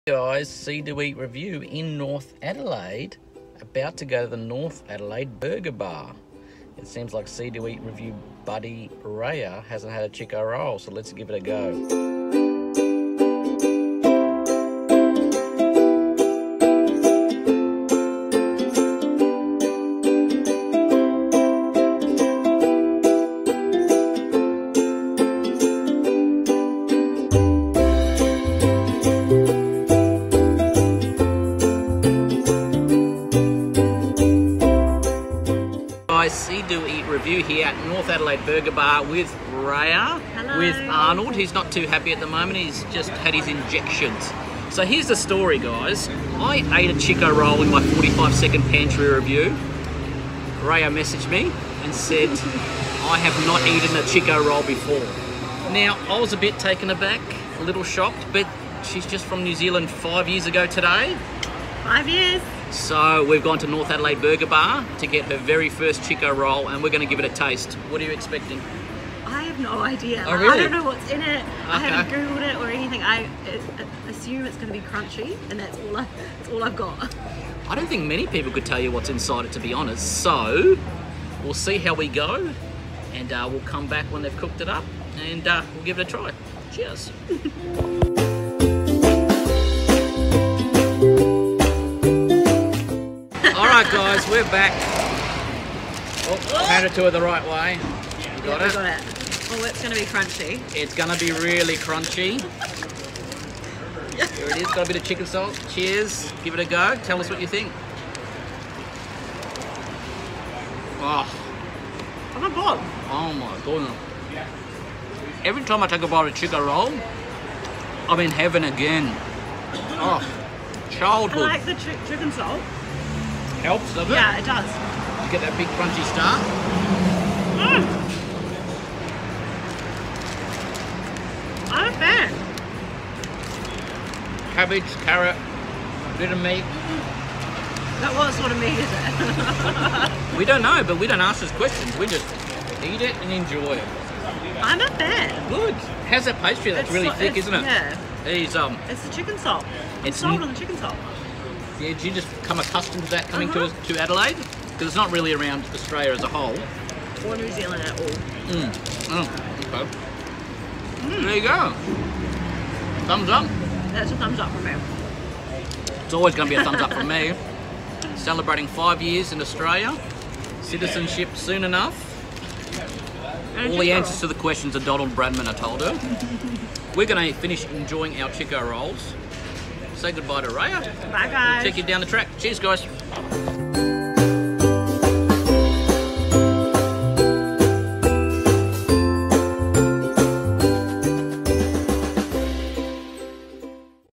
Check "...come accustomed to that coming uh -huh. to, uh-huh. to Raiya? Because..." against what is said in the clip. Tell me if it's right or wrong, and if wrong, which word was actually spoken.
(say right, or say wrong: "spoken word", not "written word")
wrong: "Adelaide", not "Raiya".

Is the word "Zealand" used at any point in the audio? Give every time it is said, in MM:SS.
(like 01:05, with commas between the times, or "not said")
00:59, 02:37.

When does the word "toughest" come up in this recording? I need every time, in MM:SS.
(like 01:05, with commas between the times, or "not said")
not said.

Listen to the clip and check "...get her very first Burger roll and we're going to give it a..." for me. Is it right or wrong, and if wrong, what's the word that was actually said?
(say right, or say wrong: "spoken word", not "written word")
wrong: "Chiko", not "Burger".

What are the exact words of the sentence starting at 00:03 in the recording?
About to go to the North Adelaide Burger Bar.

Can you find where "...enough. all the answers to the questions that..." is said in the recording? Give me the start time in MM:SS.
02:51.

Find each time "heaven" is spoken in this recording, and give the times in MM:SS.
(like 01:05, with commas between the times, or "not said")
01:58.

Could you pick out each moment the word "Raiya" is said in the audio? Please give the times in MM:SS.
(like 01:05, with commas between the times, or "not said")
00:09, 00:39, 00:50, 03:00.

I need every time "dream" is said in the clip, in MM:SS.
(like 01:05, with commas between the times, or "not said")
not said.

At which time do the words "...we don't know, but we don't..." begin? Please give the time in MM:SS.
02:20.